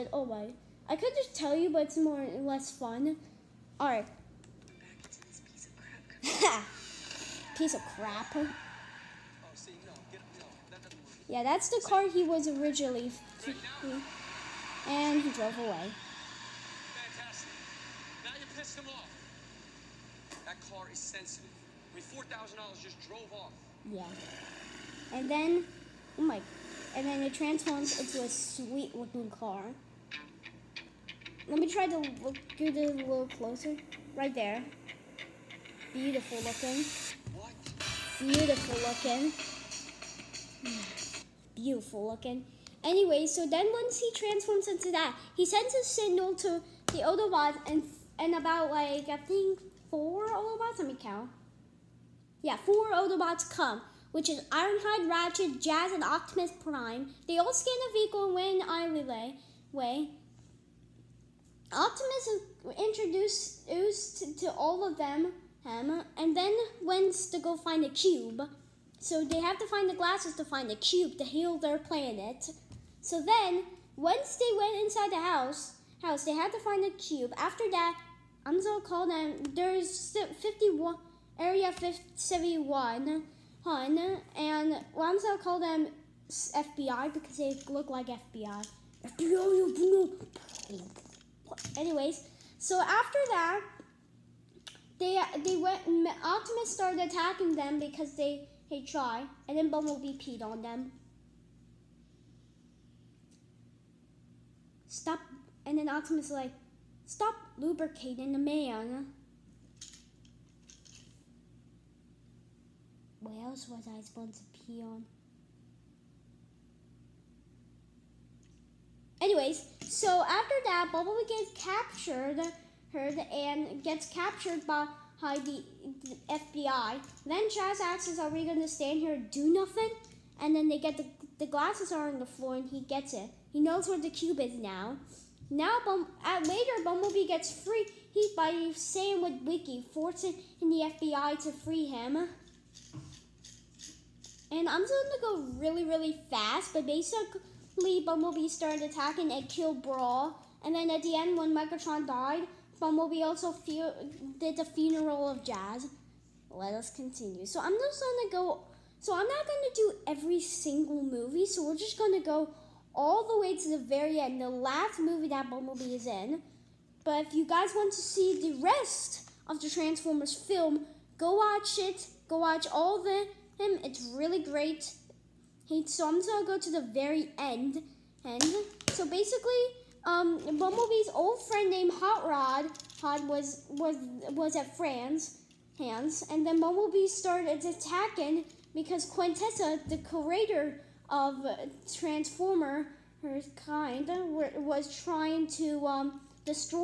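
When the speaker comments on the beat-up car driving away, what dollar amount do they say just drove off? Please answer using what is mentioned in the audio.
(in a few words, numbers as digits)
$4,000.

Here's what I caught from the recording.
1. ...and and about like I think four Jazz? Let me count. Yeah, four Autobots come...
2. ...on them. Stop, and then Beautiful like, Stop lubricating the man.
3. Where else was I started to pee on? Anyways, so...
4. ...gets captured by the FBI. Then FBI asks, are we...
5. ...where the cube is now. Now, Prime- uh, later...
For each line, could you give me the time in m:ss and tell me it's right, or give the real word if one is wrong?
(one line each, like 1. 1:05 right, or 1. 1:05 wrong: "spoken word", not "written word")
1. 0:47 wrong: "Autobots", not "Jazz"
2. 1:40 wrong: "Optimus", not "Beautiful"
3. 1:53 wrong: "supposed", not "started"
4. 2:03 wrong: "Jazz", not "FBI"
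5. 2:13 wrong: "Bum", not "Prime".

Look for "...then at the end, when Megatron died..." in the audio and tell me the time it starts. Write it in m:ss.
2:30.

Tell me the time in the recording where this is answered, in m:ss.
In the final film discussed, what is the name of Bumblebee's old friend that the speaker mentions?
3:01.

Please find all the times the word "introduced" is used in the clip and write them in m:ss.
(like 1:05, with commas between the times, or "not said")
1:02.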